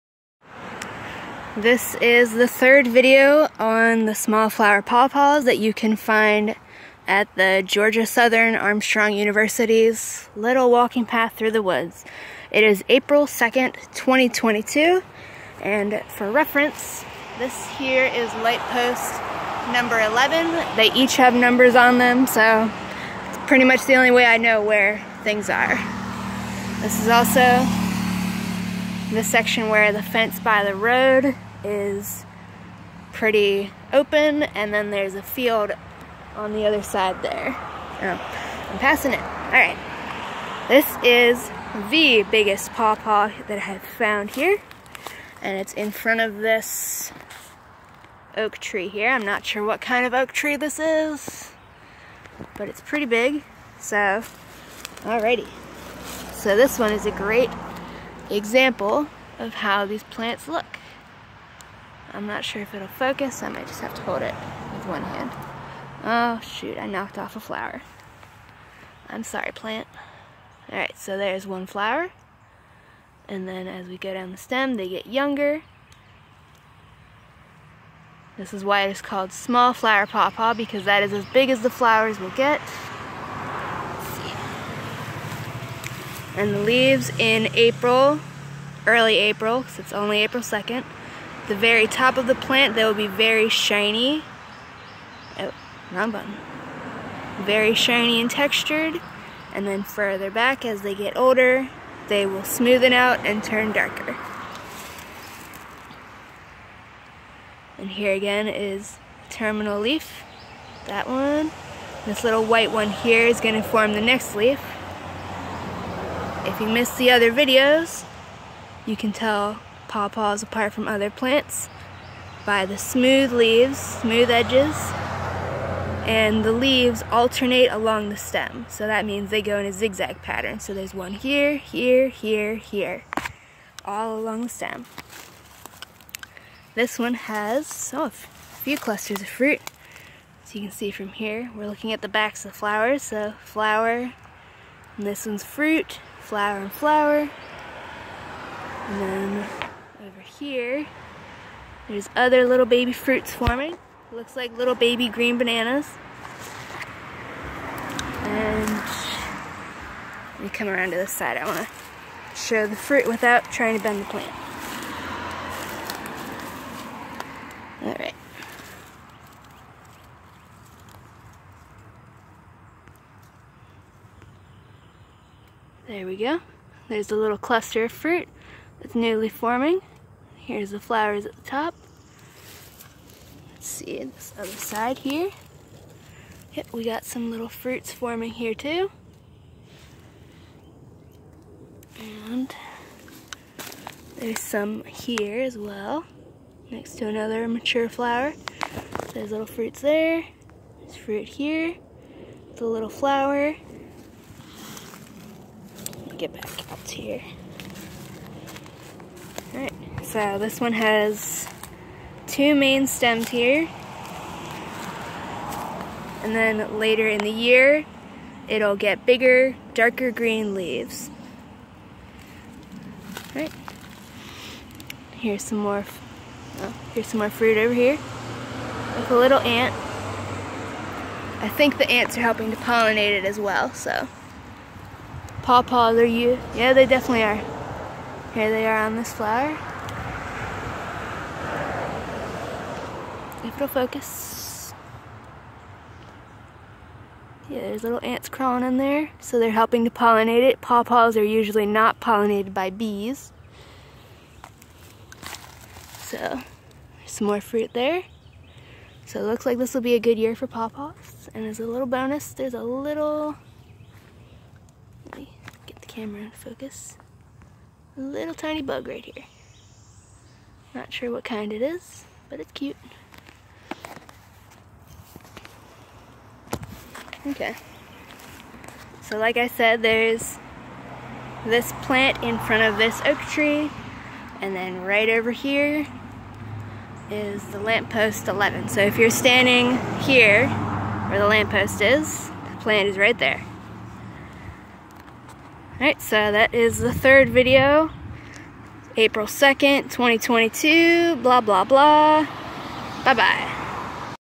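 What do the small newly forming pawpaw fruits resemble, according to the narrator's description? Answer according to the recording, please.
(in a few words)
Little baby green bananas.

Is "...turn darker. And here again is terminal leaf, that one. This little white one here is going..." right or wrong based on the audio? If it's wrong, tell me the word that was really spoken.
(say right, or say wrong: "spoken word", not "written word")
right.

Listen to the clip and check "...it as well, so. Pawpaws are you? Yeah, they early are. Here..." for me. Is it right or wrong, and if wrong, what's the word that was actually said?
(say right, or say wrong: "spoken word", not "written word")
wrong: "definitely", not "early".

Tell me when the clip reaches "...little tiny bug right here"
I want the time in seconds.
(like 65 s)
267 s.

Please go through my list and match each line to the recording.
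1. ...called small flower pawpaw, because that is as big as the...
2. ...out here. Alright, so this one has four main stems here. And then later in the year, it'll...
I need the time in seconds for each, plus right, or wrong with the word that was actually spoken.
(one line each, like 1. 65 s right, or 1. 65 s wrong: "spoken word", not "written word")
1. 79 s right
2. 206 s wrong: "two", not "four".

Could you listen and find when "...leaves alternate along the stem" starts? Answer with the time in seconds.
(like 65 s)
126 s.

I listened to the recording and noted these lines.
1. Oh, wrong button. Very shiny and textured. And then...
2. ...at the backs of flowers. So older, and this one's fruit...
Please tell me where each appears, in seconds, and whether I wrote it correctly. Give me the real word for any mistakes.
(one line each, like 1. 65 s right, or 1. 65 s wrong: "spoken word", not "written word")
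1. 95 s right
2. 141 s wrong: "flower", not "older".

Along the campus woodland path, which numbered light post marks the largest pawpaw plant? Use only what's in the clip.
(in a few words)
11.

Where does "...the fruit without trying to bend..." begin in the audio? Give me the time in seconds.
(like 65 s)
162 s.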